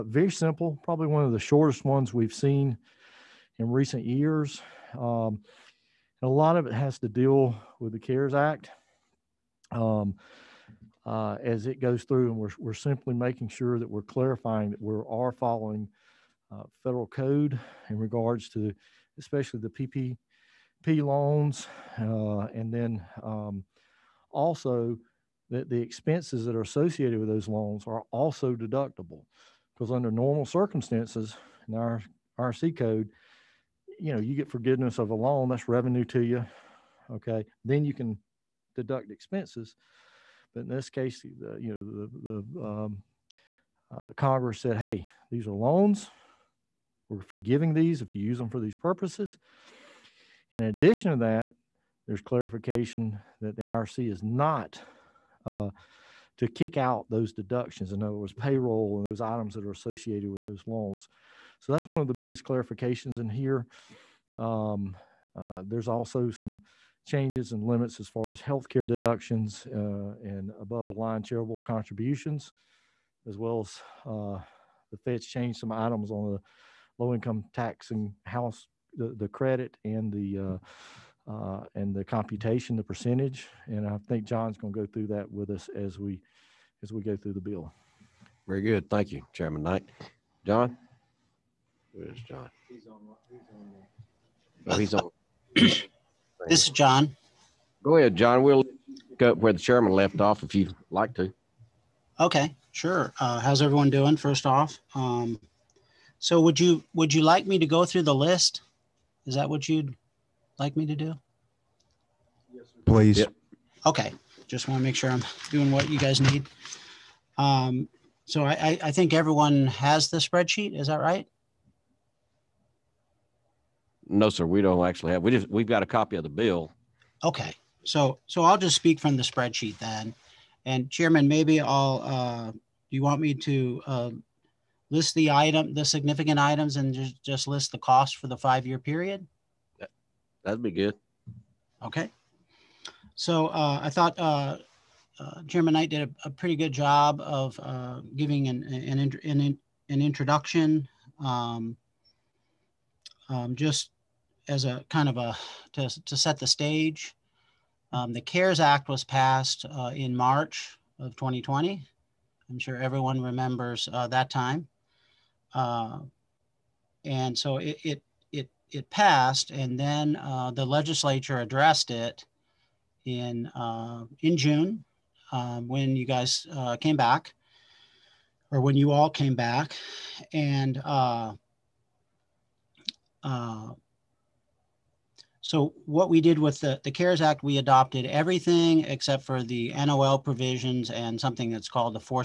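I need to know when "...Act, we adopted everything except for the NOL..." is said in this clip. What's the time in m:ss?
3:07.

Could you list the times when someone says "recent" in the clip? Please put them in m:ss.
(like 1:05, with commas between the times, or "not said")
0:03.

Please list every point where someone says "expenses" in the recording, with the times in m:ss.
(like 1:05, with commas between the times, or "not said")
0:25, 0:39.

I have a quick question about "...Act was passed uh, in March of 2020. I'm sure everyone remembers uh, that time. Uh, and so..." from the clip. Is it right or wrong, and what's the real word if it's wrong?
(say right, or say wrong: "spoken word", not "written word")
right.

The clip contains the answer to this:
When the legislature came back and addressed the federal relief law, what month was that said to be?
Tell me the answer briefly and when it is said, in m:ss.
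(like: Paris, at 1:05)
June, at 2:54.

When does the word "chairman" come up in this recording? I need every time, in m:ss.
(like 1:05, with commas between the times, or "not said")
1:29, 1:39, 2:10, 2:25.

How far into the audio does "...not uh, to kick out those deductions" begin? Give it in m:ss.
0:54.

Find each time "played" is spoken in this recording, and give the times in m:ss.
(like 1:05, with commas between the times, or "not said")
not said.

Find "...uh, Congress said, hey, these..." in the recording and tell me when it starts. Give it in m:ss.
0:43.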